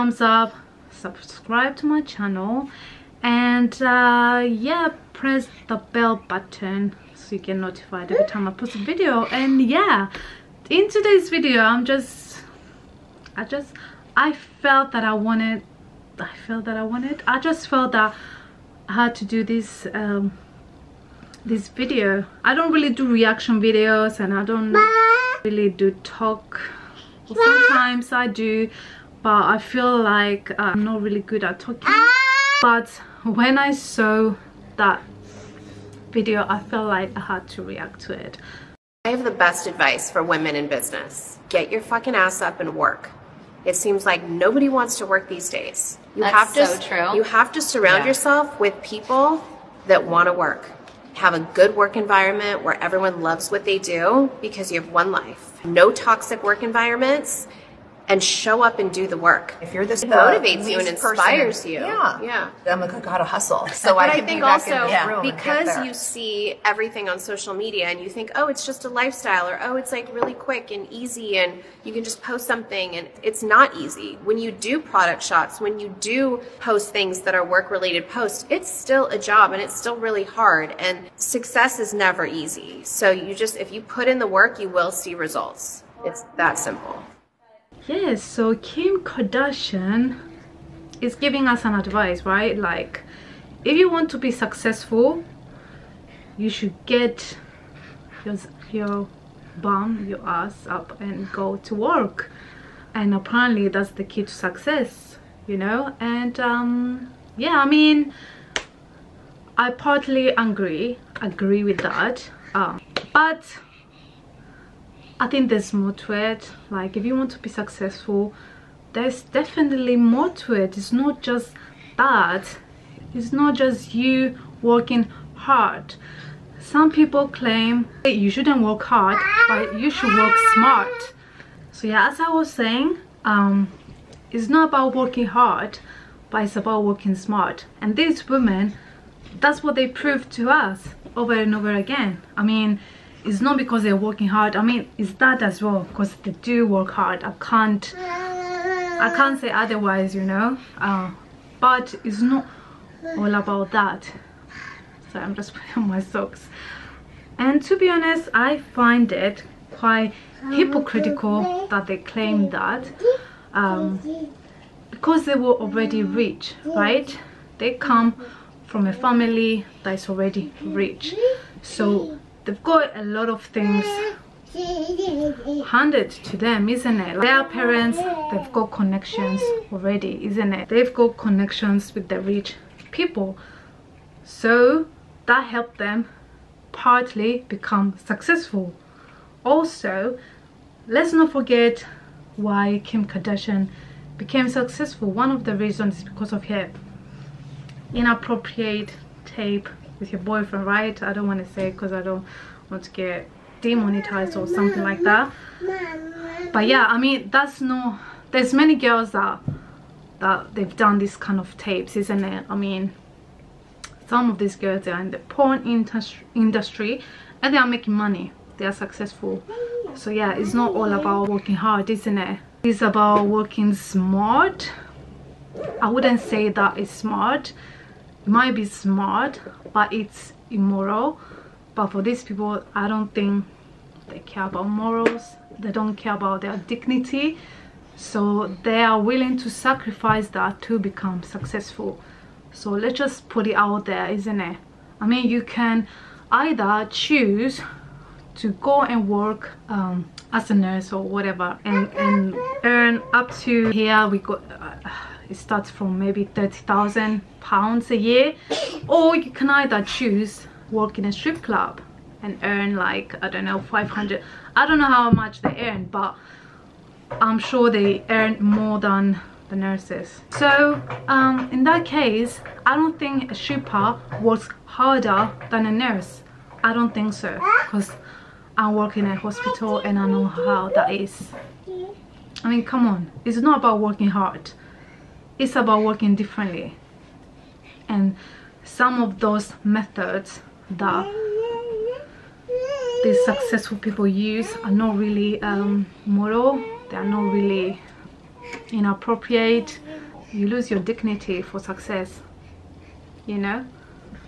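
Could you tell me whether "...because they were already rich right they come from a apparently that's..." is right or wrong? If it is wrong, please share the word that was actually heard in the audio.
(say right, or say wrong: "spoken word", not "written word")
wrong: "family", not "apparently".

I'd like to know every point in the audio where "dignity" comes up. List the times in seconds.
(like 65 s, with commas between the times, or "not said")
236 s, 300 s.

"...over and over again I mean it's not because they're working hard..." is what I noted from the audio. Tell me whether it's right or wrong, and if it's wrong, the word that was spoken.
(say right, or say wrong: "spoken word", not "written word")
right.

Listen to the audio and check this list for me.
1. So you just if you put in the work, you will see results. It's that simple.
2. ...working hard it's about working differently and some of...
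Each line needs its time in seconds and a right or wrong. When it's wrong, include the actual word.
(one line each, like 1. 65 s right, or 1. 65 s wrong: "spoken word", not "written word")
1. 82 s right
2. 283 s right.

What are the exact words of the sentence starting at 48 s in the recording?
yourself with people that want to work.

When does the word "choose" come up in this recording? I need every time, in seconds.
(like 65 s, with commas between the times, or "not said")
246 s, 259 s.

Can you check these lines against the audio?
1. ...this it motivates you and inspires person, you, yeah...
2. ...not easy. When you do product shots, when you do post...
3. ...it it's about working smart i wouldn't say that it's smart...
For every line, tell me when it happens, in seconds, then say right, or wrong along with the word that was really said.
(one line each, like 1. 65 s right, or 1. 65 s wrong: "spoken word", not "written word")
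1. 59 s right
2. 73 s right
3. 222 s right.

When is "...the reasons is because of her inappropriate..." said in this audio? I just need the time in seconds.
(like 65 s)
195 s.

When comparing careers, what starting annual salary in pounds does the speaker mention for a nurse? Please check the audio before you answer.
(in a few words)
30,000 pounds.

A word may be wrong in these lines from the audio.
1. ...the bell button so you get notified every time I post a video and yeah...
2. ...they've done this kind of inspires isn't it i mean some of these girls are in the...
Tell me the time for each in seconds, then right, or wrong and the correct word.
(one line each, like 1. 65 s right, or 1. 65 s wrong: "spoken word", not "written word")
1. 5 s right
2. 210 s wrong: "tapes", not "inspires".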